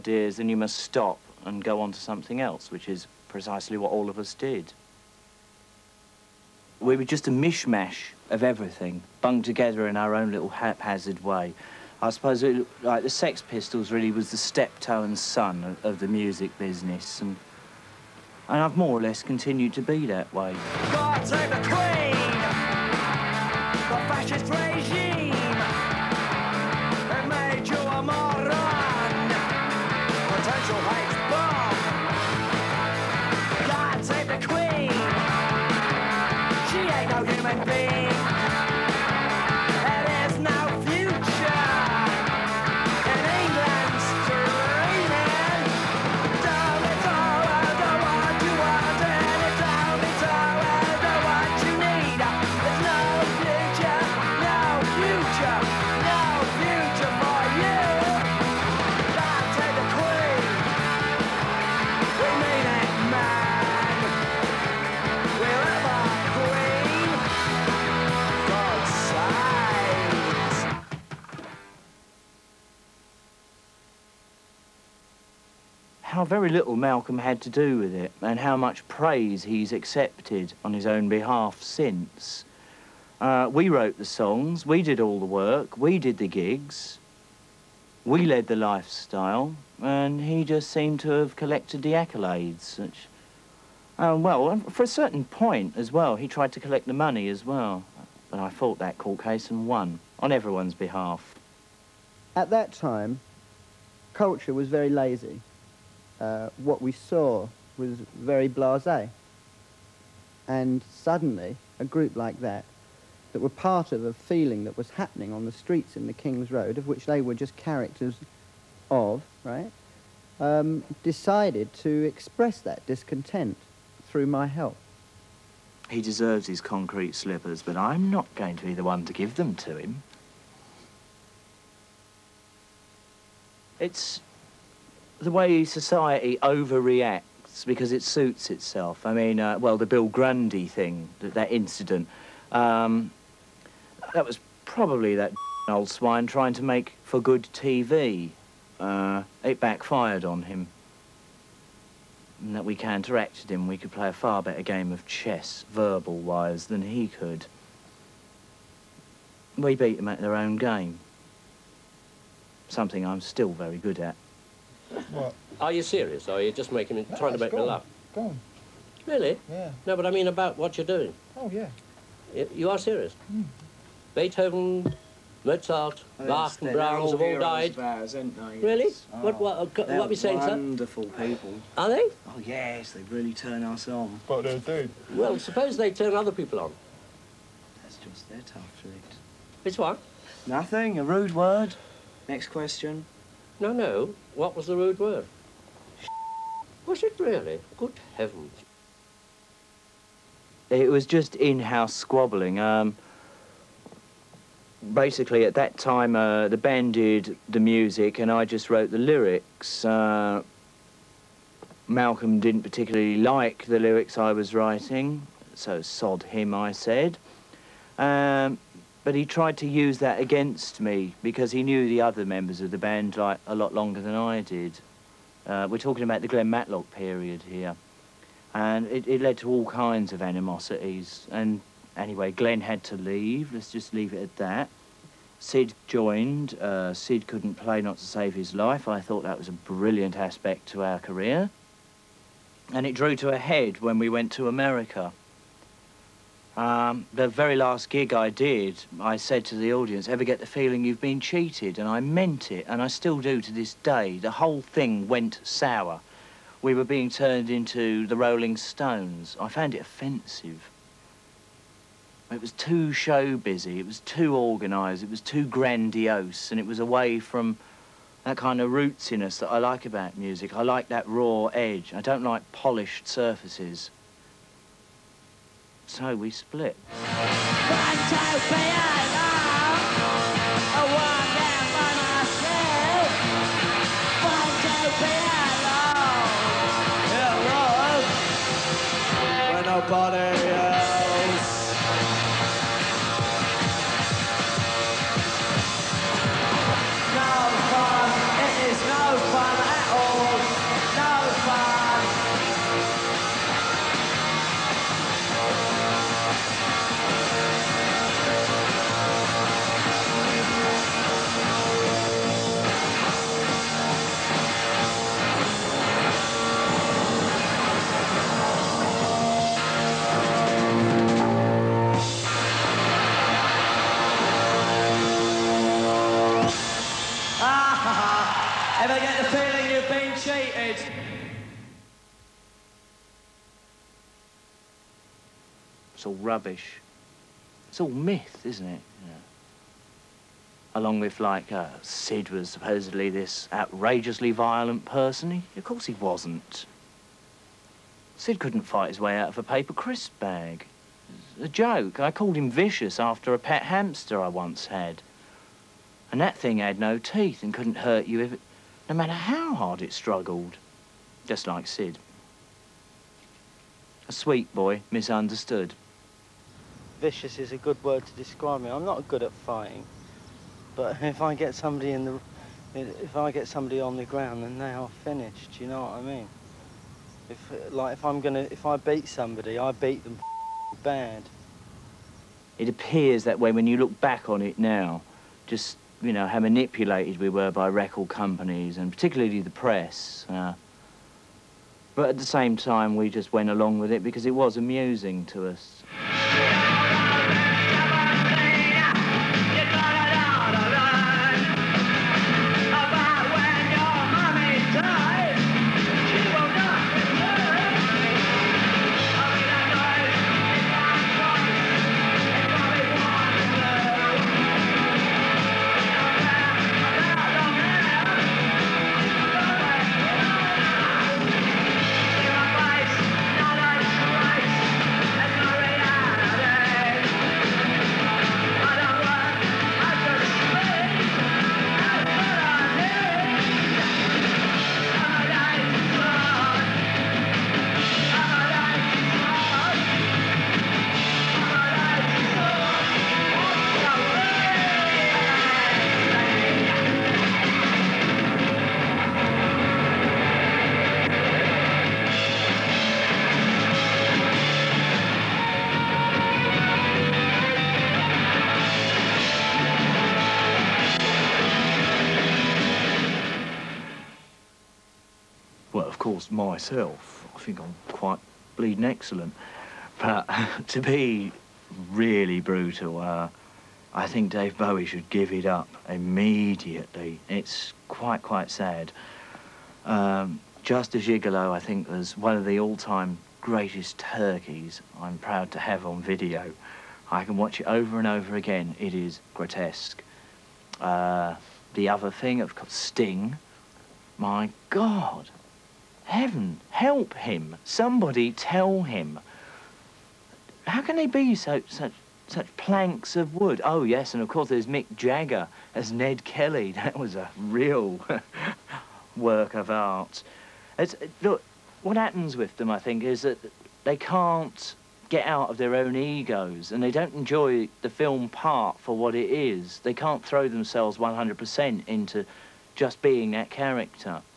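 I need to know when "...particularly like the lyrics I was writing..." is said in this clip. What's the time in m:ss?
3:32.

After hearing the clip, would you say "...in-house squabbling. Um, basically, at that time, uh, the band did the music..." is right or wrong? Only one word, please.
right.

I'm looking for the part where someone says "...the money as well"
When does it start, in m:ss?
1:36.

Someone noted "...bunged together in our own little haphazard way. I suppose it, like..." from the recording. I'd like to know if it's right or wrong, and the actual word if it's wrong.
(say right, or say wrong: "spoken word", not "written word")
right.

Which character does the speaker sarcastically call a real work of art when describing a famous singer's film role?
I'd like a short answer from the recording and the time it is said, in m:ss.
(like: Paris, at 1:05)
Ned Kelly, at 8:25.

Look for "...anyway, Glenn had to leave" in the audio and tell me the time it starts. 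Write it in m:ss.
3:51.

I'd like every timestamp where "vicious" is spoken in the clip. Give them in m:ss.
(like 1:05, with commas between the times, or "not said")
5:52, 6:07.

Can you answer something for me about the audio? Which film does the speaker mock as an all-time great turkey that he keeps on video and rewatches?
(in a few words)
Just a Gigolo.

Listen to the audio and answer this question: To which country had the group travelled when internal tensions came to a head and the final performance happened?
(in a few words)
America.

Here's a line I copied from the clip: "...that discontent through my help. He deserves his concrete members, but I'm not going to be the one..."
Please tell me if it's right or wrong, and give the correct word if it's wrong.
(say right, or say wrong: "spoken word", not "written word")
wrong: "slippers", not "members".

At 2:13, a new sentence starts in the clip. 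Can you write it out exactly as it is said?
It's the way society overreacts because it suits itself.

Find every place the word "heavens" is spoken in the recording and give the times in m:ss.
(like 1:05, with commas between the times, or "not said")
3:18, 8:16.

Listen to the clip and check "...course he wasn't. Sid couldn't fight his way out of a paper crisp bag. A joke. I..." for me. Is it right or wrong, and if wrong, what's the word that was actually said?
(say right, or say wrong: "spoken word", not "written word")
right.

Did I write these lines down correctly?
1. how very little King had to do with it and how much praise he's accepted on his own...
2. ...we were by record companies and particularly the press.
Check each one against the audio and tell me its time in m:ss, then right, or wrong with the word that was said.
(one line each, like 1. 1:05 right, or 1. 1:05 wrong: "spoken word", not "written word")
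1. 1:16 wrong: "Malcolm", not "King"
2. 6:27 right.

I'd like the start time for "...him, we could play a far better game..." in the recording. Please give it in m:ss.
2:33.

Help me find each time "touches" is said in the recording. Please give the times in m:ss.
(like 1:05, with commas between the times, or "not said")
not said.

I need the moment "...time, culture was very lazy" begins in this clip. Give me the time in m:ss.
1:42.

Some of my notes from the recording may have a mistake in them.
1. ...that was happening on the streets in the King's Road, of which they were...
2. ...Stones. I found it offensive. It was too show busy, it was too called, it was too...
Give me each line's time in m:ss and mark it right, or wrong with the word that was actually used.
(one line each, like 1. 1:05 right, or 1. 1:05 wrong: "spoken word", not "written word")
1. 1:54 right
2. 4:18 wrong: "organised", not "called".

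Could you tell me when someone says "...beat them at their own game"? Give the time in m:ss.
2:39.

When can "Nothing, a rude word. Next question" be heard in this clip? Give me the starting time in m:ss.
3:10.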